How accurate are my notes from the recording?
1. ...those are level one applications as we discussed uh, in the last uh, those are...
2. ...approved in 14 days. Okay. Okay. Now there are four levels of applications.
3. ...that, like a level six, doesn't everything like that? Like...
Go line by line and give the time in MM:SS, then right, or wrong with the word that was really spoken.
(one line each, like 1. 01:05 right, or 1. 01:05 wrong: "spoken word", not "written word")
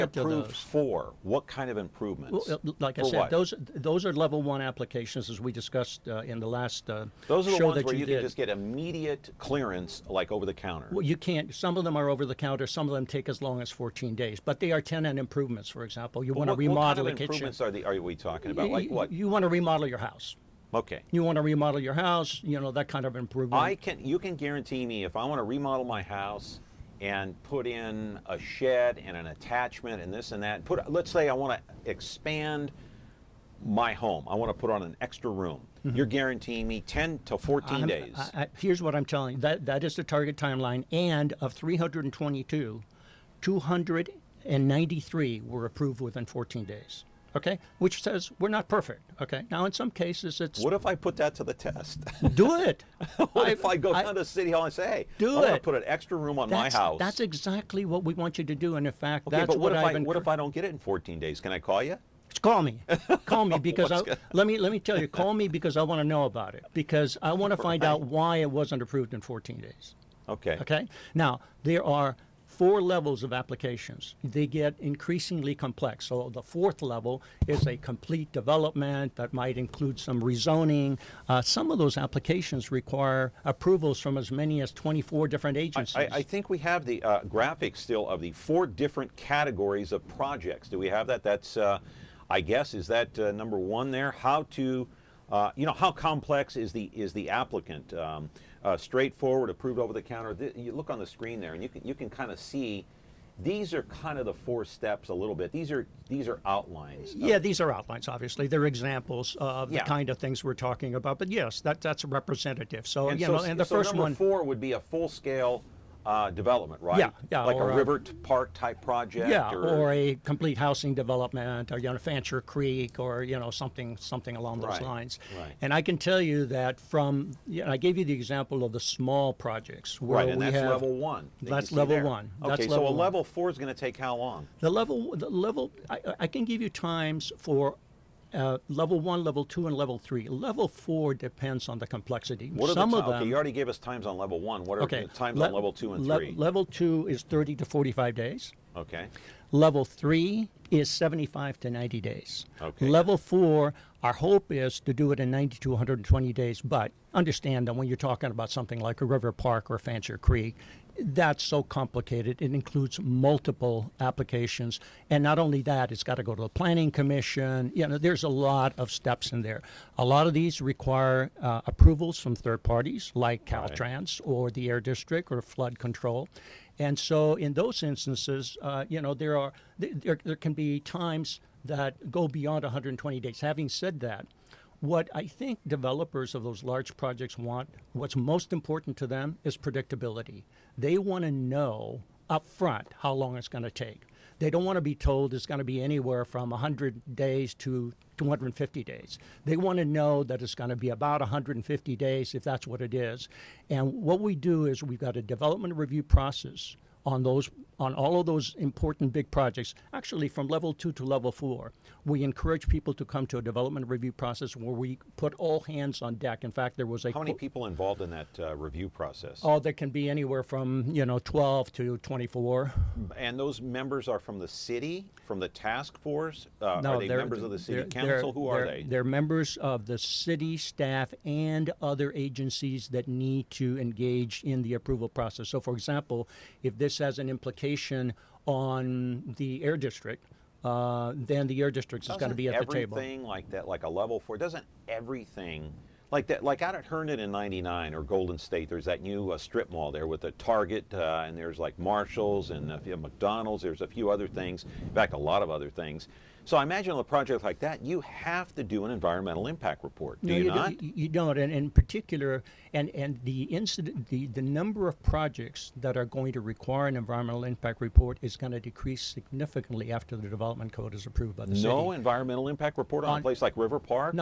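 1. 00:03 right
2. 01:08 right
3. 04:03 wrong: "four", not "six".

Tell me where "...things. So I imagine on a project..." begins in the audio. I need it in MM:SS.
04:15.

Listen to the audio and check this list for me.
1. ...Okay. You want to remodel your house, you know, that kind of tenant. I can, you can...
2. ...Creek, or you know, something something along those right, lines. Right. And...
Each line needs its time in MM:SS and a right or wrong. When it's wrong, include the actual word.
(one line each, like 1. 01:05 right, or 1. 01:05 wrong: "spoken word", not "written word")
1. 00:20 wrong: "improvement", not "tenant"
2. 02:02 right.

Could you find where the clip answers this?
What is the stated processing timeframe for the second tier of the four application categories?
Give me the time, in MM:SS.
02:27.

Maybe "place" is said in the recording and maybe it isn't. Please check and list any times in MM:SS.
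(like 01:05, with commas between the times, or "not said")
04:33.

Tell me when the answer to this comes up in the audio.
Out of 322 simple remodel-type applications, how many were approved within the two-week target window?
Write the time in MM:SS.
00:43.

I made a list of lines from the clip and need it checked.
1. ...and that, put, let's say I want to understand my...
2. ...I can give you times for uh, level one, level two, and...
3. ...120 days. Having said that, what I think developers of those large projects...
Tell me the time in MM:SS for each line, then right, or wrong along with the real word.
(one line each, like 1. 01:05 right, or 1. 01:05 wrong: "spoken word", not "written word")
1. 00:30 wrong: "expand", not "understand"
2. 02:16 right
3. 03:02 right.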